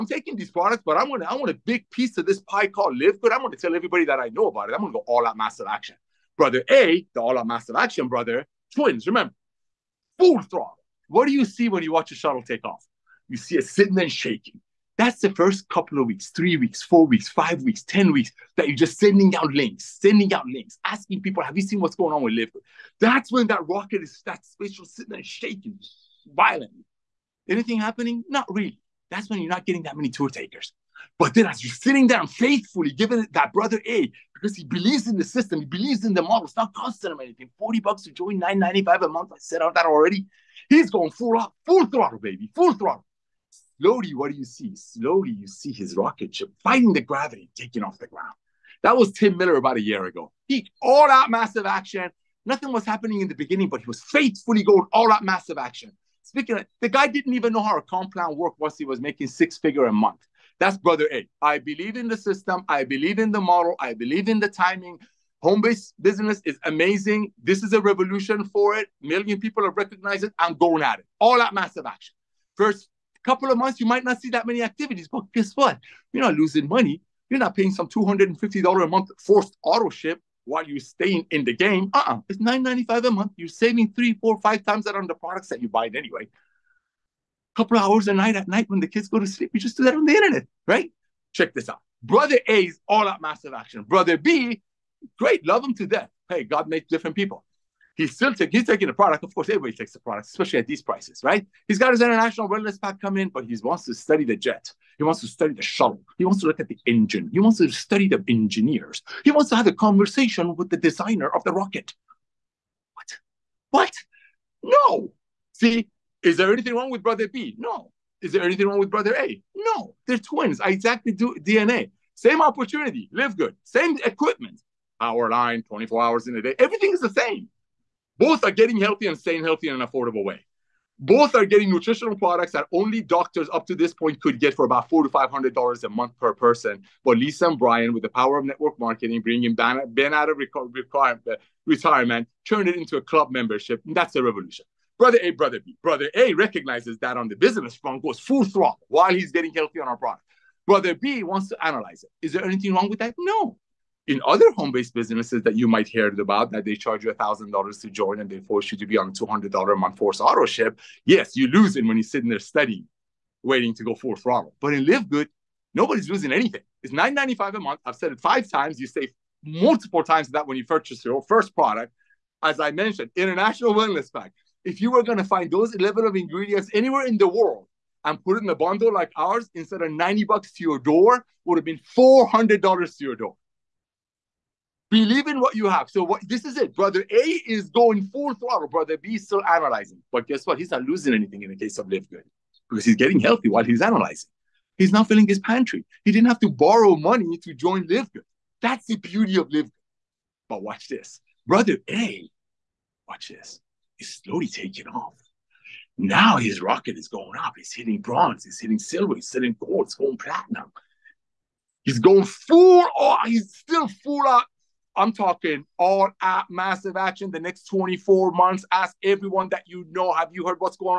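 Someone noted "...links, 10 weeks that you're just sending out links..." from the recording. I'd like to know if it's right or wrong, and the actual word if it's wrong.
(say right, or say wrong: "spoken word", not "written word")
wrong: "weeks", not "links".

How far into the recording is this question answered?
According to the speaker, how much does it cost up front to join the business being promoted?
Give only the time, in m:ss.
0:37.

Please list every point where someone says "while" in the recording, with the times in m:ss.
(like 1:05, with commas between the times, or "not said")
1:20, 2:28, 3:13.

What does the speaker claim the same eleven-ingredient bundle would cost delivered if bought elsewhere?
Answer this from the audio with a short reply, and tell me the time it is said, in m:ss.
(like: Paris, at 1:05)
$400, at 3:01.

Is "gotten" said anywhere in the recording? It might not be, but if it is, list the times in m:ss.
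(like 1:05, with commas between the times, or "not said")
not said.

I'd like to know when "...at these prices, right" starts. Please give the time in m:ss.
1:40.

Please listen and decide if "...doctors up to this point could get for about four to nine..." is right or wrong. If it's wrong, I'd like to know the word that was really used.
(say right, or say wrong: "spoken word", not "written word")
wrong: "five", not "nine".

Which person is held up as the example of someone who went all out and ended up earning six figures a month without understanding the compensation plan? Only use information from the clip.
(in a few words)
Tim Miller.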